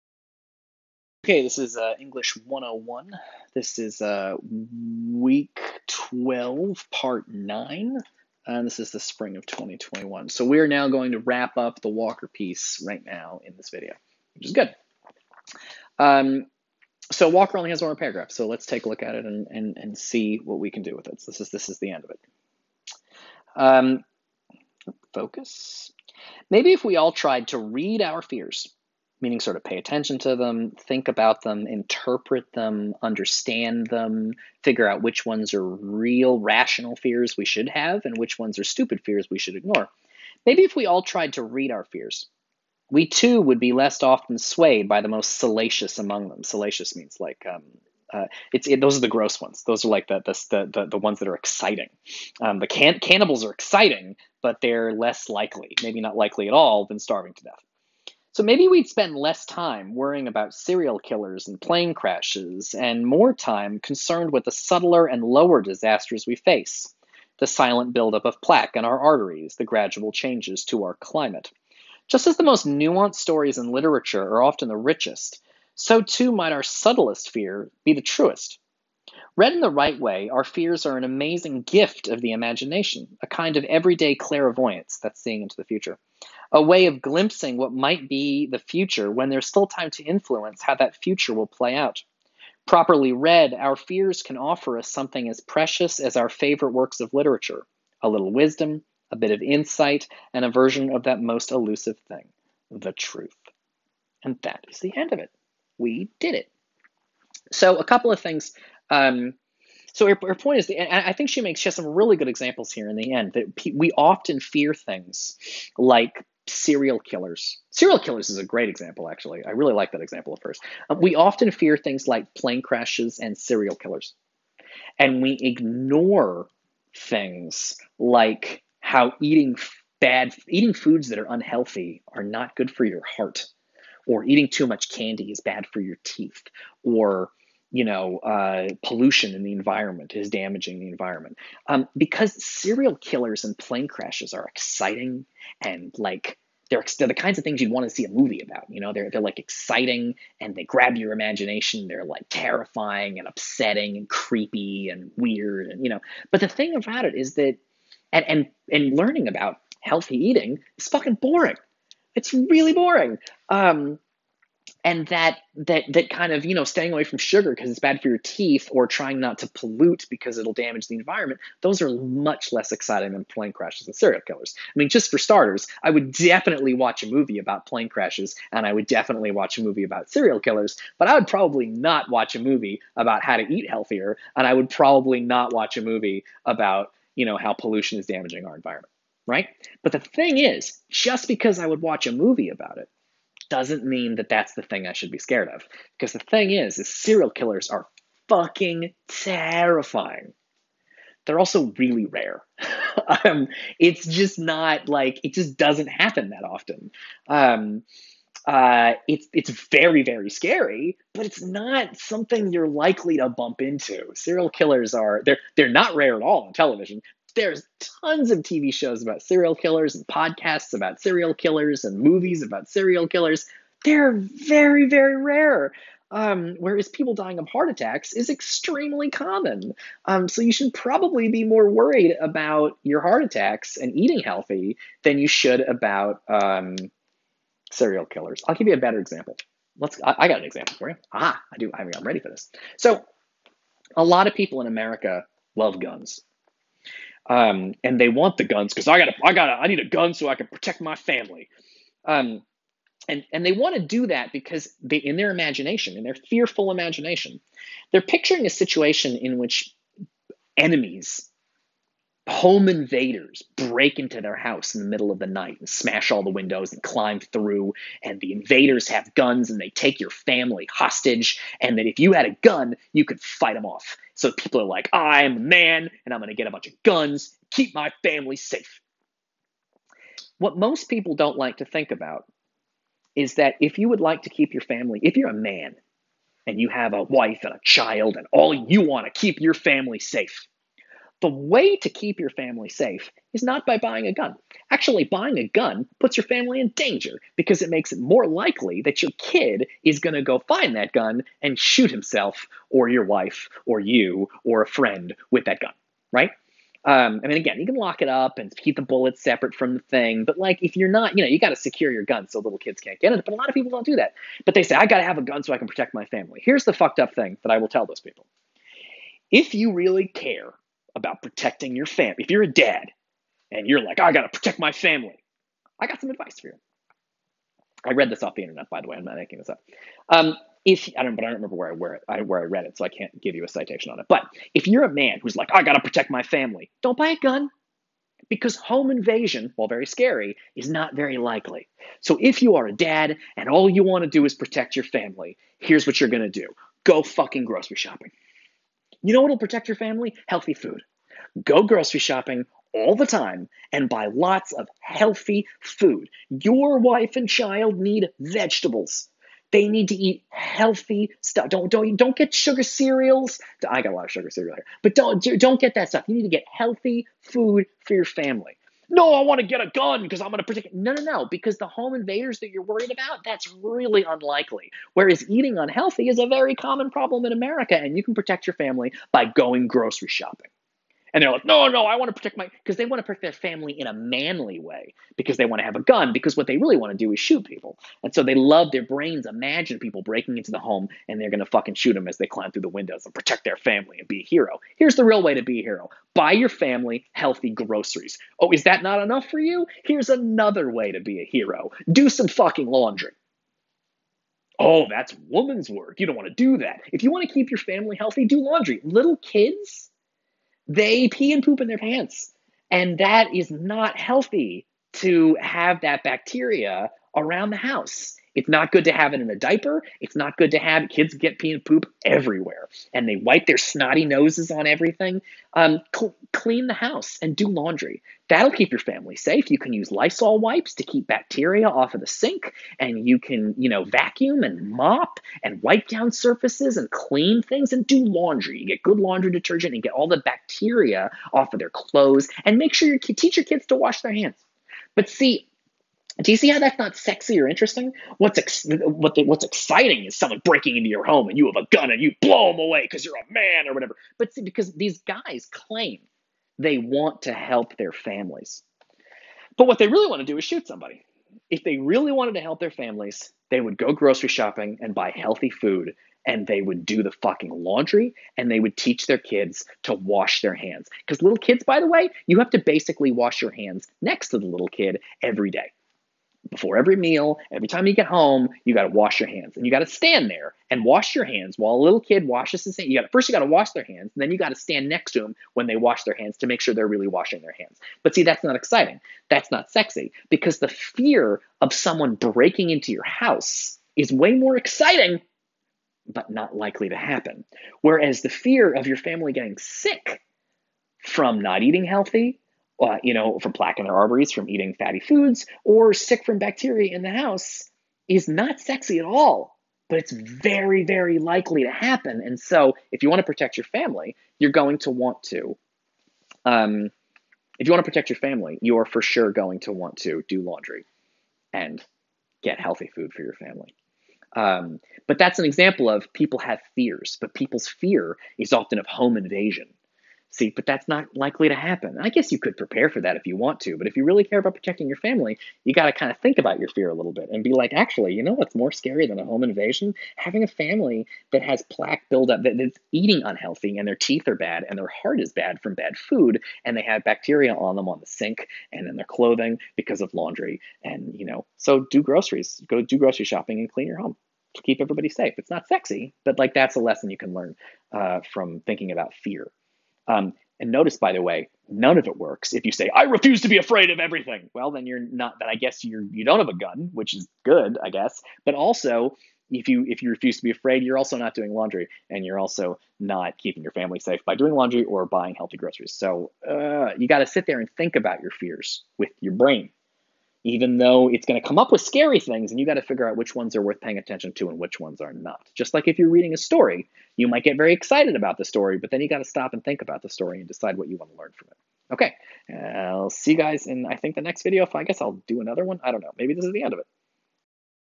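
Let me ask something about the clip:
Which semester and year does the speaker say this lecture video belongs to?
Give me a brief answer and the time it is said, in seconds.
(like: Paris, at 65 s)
Spring 2021, at 8 s.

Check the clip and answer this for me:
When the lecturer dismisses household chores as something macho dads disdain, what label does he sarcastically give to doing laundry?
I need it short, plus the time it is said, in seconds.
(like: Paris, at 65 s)
Woman's work, at 405 s.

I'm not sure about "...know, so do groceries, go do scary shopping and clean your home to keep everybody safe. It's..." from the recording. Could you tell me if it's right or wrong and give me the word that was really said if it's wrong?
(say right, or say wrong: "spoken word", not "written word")
wrong: "grocery", not "scary".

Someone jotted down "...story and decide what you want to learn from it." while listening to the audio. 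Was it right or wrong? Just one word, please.
right.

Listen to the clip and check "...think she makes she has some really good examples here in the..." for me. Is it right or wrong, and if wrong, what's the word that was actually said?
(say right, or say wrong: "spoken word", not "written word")
right.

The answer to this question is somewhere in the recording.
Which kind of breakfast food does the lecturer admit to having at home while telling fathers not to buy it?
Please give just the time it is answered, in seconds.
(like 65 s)
364 s.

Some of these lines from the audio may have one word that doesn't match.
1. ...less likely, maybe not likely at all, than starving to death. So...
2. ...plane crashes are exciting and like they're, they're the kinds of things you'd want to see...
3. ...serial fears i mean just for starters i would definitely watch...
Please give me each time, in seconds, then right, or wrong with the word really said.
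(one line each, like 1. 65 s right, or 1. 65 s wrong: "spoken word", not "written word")
1. 54 s right
2. 143 s right
3. 173 s wrong: "killers", not "fears".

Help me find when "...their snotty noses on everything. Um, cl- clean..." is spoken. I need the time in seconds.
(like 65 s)
423 s.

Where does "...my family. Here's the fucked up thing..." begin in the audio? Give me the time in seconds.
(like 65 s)
315 s.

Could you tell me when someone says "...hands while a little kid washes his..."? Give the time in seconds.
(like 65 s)
481 s.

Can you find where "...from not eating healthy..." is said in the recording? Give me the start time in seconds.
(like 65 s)
501 s.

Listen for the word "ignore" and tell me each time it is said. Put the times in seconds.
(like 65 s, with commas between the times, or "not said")
39 s, 125 s.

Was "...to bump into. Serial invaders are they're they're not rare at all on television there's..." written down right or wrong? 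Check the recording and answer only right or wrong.
wrong.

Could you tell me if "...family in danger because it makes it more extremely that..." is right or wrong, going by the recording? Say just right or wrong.
wrong.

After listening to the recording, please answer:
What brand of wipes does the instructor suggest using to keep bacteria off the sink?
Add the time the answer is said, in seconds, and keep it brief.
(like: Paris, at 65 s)
Lysol, at 429 s.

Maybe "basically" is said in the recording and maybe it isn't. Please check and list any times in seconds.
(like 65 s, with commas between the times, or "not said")
472 s.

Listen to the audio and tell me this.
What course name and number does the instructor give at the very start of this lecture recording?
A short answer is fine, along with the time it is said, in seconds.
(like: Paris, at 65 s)
English 101, at 1 s.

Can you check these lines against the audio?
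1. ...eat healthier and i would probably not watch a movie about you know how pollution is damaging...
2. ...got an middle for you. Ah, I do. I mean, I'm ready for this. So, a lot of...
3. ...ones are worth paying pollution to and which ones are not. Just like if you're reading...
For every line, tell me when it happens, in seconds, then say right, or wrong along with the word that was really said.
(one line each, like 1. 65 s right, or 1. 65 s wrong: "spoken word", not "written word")
1. 183 s right
2. 240 s wrong: "example", not "middle"
3. 583 s wrong: "attention", not "pollution".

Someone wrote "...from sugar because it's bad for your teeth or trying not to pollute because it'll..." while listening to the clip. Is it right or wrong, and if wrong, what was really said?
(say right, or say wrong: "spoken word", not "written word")
right.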